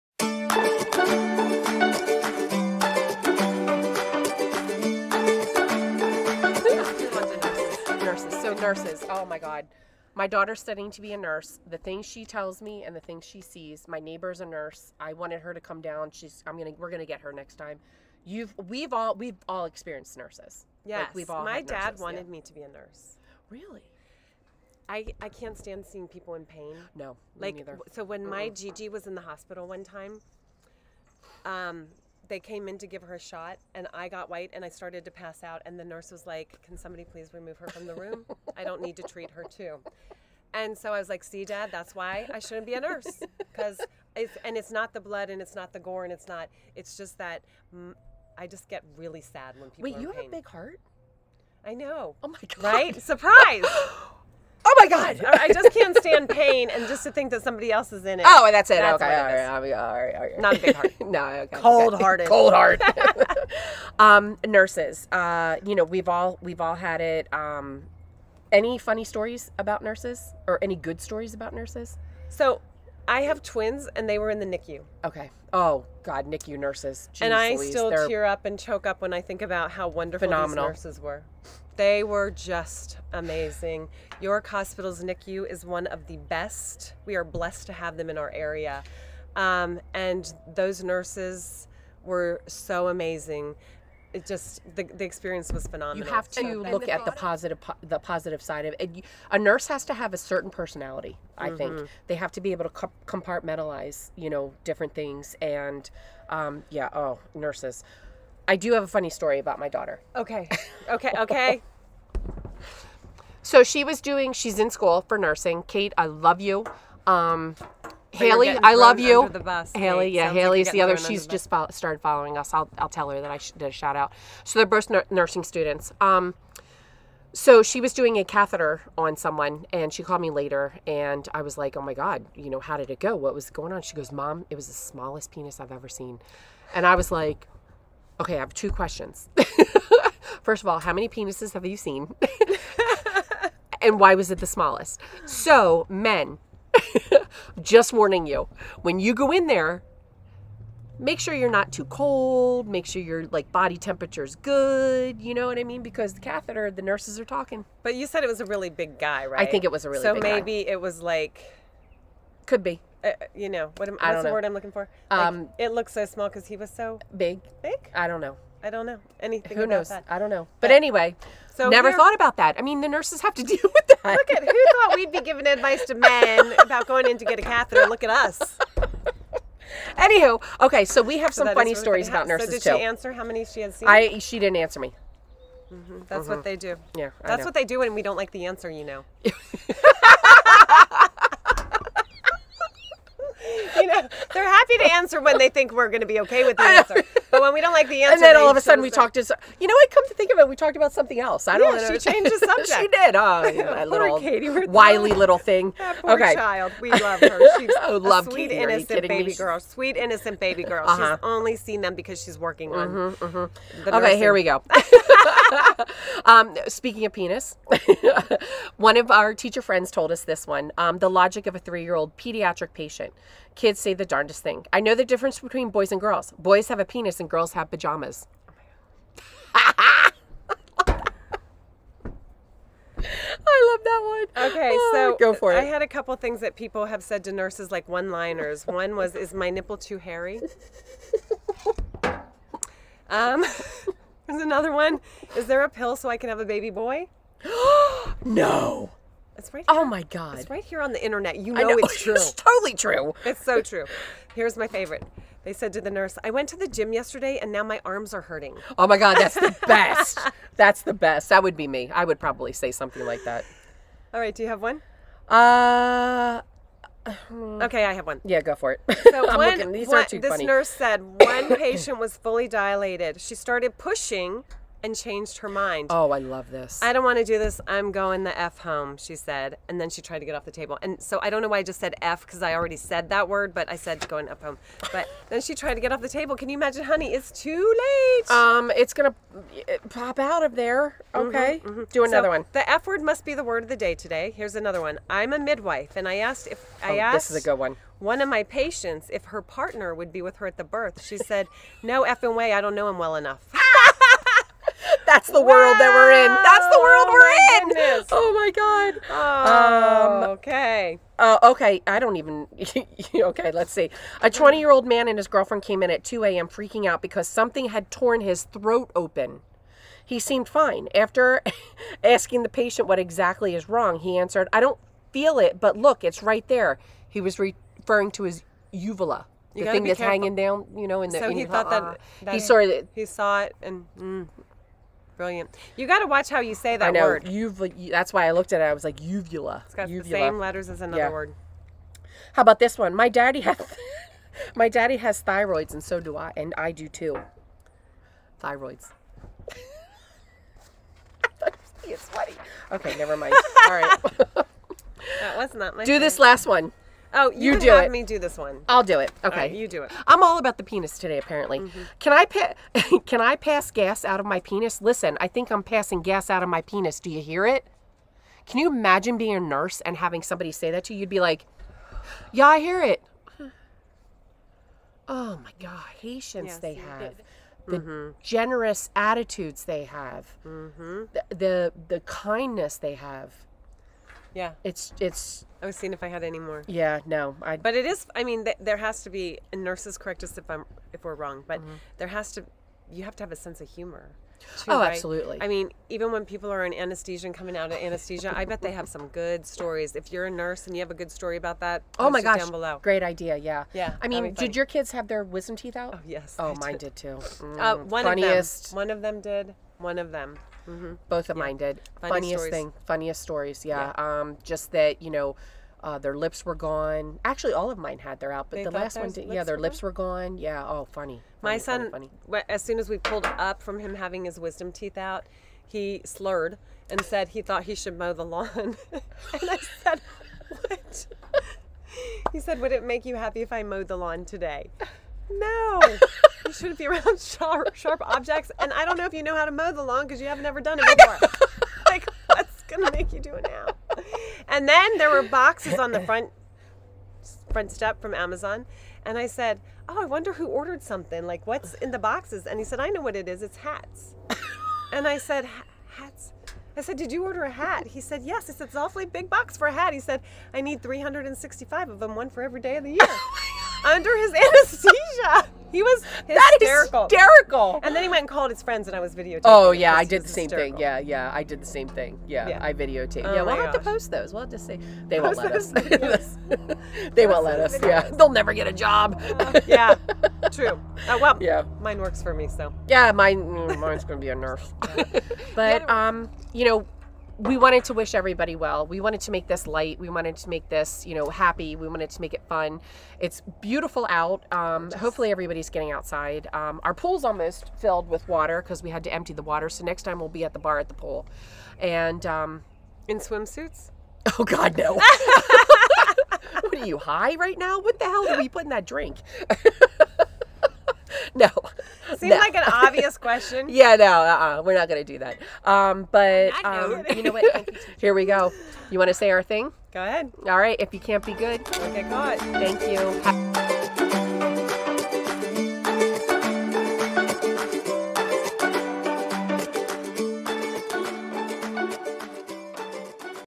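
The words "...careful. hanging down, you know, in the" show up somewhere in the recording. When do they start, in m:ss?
5:29.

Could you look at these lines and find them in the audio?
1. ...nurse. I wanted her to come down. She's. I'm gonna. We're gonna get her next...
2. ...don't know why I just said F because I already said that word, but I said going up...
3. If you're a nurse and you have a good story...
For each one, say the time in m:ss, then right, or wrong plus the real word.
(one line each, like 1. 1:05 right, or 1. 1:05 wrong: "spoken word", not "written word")
1. 0:14 right
2. 4:41 right
3. 6:39 right.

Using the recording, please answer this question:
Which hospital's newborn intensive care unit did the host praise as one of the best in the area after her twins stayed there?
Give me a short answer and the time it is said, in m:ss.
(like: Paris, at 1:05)
York Hospital, at 1:24.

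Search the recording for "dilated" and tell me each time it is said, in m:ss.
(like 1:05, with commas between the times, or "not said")
4:32.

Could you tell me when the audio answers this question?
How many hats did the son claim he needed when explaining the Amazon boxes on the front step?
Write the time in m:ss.
7:40.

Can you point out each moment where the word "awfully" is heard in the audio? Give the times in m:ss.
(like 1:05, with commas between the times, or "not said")
7:38.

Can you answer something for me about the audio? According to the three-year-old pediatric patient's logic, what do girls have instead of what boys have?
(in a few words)
Pajamas.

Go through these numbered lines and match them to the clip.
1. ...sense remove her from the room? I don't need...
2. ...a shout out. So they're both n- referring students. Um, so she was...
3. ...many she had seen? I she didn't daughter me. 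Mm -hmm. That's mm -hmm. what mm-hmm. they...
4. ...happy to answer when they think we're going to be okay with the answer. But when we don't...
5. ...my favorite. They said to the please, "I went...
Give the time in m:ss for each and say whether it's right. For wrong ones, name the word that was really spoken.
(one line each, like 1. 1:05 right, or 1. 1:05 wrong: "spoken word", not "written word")
1. 0:37 wrong: "please", not "sense"
2. 2:03 wrong: "nursing", not "referring"
3. 3:03 wrong: "answer", not "daughter"
4. 3:14 right
5. 4:14 wrong: "nurse", not "please".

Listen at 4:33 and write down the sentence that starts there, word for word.
She started pushing and changed her mind.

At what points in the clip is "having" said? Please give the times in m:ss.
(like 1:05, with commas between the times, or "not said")
6:09, 7:03.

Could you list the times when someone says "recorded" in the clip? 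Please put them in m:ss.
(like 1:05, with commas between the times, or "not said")
not said.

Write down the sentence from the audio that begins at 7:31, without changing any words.
Like, what's in the boxes?" And he said, "I know what it is.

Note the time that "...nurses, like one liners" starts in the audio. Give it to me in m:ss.
3:57.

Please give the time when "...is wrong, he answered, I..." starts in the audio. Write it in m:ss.
5:23.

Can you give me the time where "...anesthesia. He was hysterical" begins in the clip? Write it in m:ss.
7:44.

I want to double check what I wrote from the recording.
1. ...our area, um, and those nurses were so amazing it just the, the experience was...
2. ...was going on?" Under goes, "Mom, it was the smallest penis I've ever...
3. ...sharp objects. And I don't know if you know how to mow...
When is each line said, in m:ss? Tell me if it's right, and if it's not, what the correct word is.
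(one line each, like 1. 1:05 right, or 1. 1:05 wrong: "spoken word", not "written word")
1. 1:28 right
2. 2:13 wrong: "She", not "Under"
3. 7:17 right.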